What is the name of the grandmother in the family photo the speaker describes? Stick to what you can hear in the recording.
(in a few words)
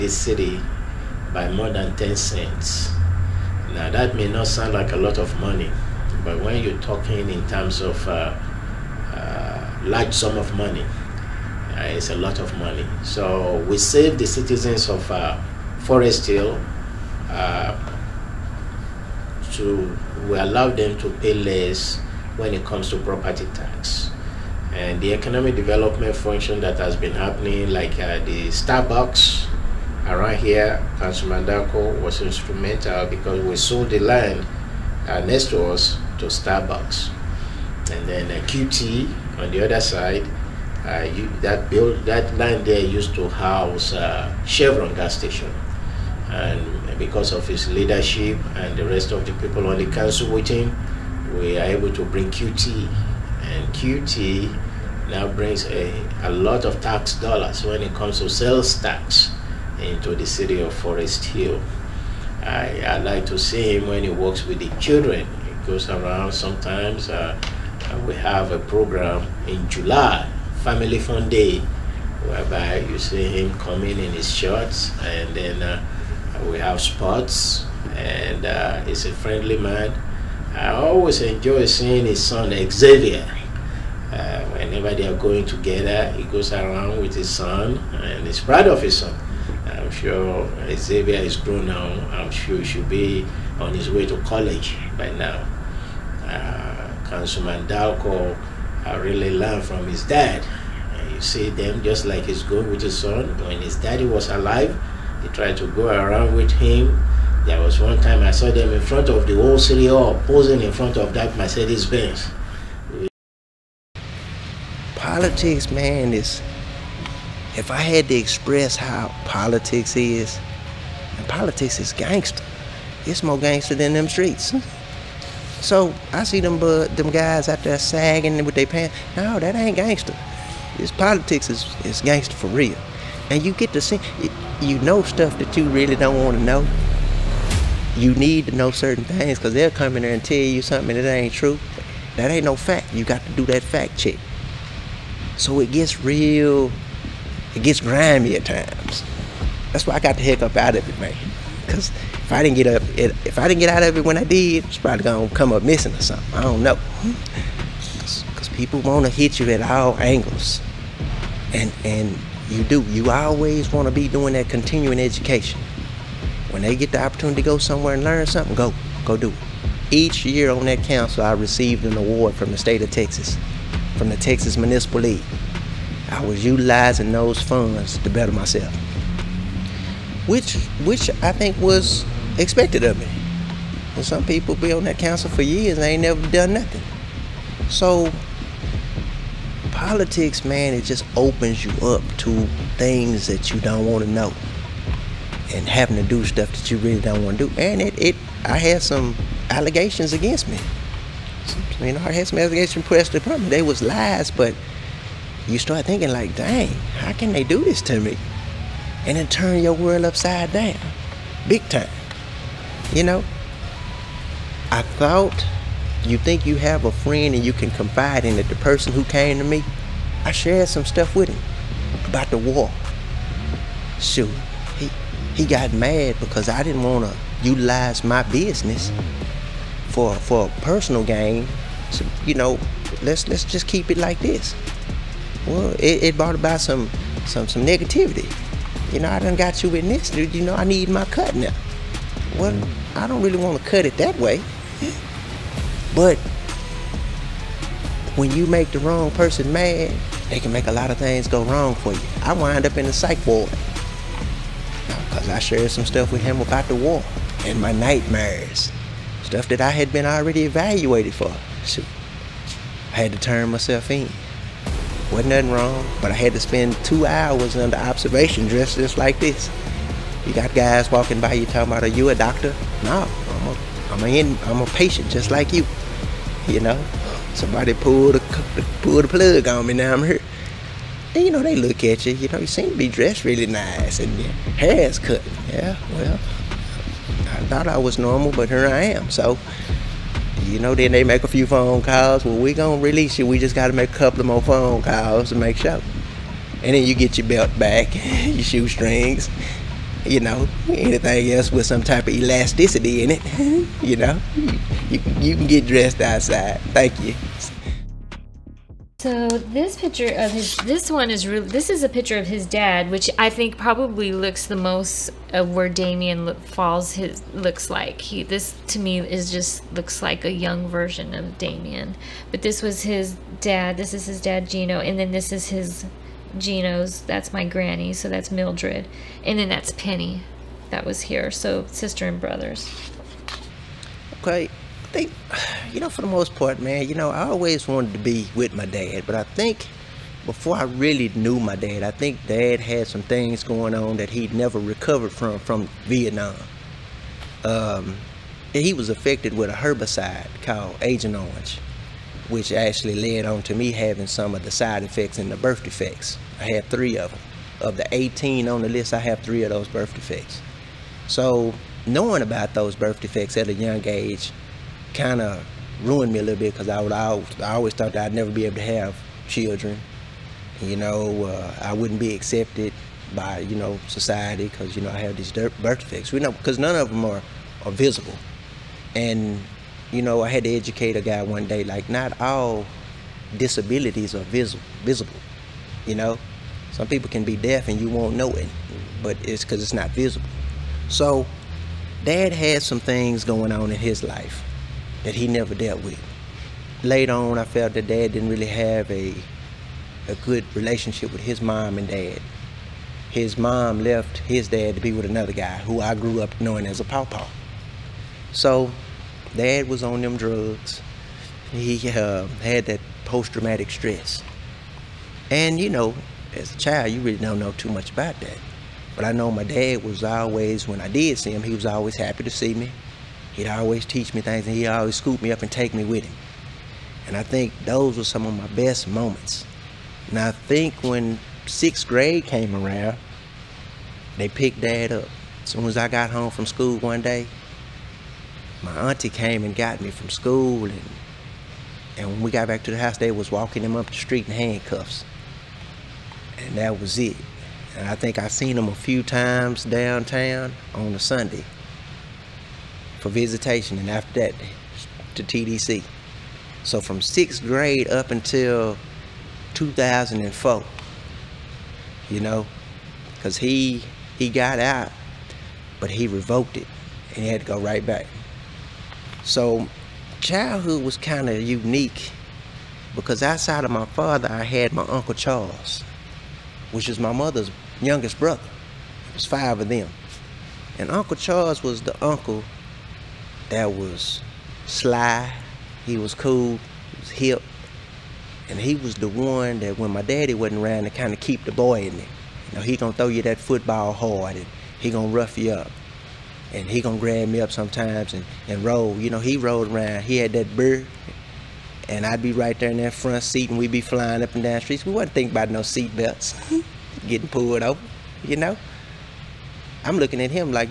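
Mildred.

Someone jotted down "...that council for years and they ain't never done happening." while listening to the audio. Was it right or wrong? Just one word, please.
wrong.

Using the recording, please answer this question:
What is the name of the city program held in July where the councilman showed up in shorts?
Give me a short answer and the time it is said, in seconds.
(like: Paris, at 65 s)
Family Fun Day, at 70 s.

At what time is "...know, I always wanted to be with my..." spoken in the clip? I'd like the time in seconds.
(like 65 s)
336 s.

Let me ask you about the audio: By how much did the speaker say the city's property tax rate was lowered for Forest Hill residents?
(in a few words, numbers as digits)
more than 10 cents.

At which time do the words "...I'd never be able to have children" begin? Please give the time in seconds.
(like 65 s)
368 s.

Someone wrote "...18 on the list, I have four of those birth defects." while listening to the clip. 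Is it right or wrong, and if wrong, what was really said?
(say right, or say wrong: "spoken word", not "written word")
wrong: "three", not "four".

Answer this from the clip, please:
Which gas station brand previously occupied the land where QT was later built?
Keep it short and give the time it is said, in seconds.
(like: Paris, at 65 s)
Chevron, at 44 s.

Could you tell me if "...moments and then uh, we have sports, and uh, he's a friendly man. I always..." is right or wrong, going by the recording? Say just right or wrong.
wrong.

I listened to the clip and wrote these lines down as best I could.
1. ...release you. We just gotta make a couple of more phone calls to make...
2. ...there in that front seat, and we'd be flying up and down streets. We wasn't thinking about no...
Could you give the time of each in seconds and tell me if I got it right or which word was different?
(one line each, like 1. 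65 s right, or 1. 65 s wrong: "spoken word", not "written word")
1. 292 s right
2. 502 s right.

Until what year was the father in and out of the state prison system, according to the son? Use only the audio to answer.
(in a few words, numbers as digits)
2004.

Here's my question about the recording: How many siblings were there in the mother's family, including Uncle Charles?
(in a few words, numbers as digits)
5.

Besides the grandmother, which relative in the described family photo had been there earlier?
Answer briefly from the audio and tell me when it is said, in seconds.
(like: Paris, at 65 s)
Penny, at 329 s.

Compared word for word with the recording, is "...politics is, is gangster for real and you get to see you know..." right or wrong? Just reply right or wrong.
right.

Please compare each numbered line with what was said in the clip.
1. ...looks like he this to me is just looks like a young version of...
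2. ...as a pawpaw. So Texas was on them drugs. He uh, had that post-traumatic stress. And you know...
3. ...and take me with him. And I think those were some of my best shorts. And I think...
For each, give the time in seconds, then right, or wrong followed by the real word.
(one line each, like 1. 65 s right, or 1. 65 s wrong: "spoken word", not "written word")
1. 317 s right
2. 406 s wrong: "Dad", not "Texas"
3. 425 s wrong: "moments", not "shorts".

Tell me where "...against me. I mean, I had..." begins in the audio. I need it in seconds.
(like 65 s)
200 s.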